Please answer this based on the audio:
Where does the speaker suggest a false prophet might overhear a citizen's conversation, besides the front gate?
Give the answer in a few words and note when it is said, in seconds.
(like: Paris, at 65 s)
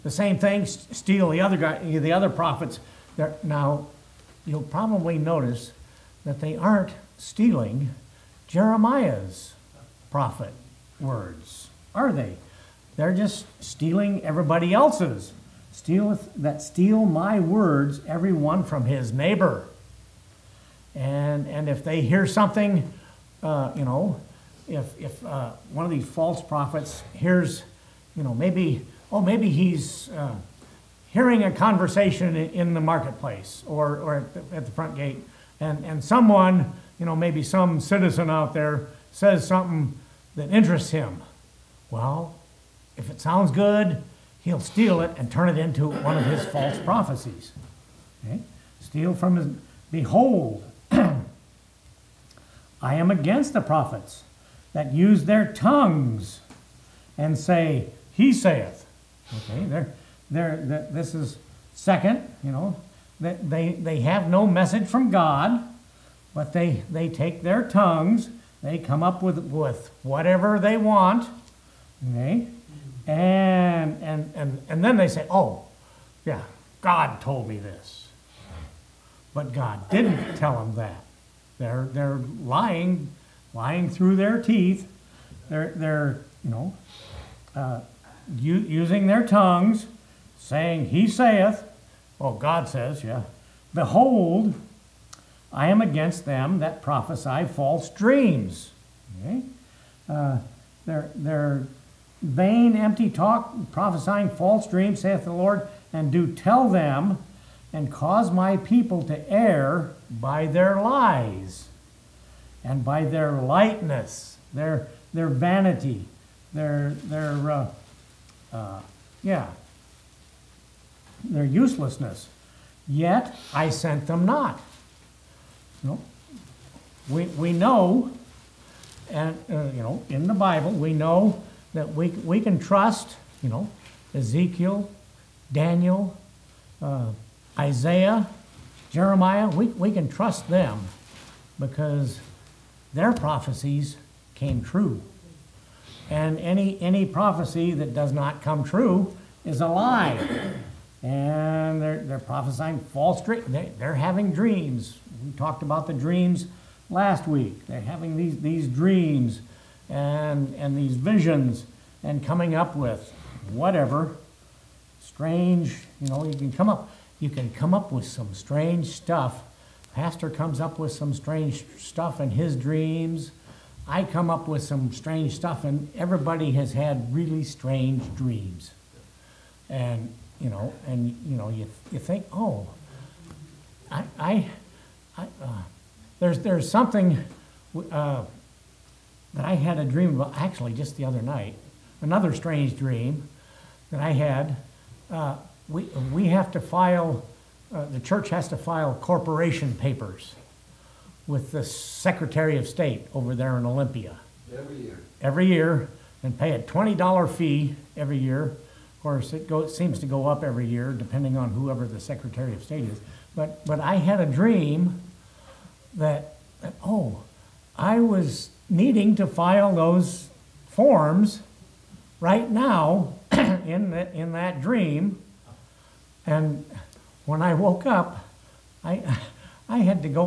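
The marketplace, at 32 s.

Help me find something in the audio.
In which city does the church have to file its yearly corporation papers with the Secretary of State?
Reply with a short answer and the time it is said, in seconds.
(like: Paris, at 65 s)
Olympia, at 203 s.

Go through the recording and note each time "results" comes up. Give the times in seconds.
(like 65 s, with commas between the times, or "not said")
not said.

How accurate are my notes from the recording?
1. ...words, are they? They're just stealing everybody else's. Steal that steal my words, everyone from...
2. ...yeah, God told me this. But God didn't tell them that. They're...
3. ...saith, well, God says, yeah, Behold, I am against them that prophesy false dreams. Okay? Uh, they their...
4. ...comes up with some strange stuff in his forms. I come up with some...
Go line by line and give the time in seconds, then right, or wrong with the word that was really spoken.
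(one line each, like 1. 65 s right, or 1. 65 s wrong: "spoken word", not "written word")
1. 10 s right
2. 76 s right
3. 91 s right
4. 170 s wrong: "dreams", not "forms".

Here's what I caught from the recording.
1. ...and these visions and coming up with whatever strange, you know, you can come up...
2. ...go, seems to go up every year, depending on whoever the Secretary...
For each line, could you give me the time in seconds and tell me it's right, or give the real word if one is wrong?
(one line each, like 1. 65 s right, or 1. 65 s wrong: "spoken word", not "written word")
1. 160 s right
2. 209 s right.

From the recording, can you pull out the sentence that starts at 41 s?
Well, if it sounds good, he'll steal it and turn it into one of his false prophecies.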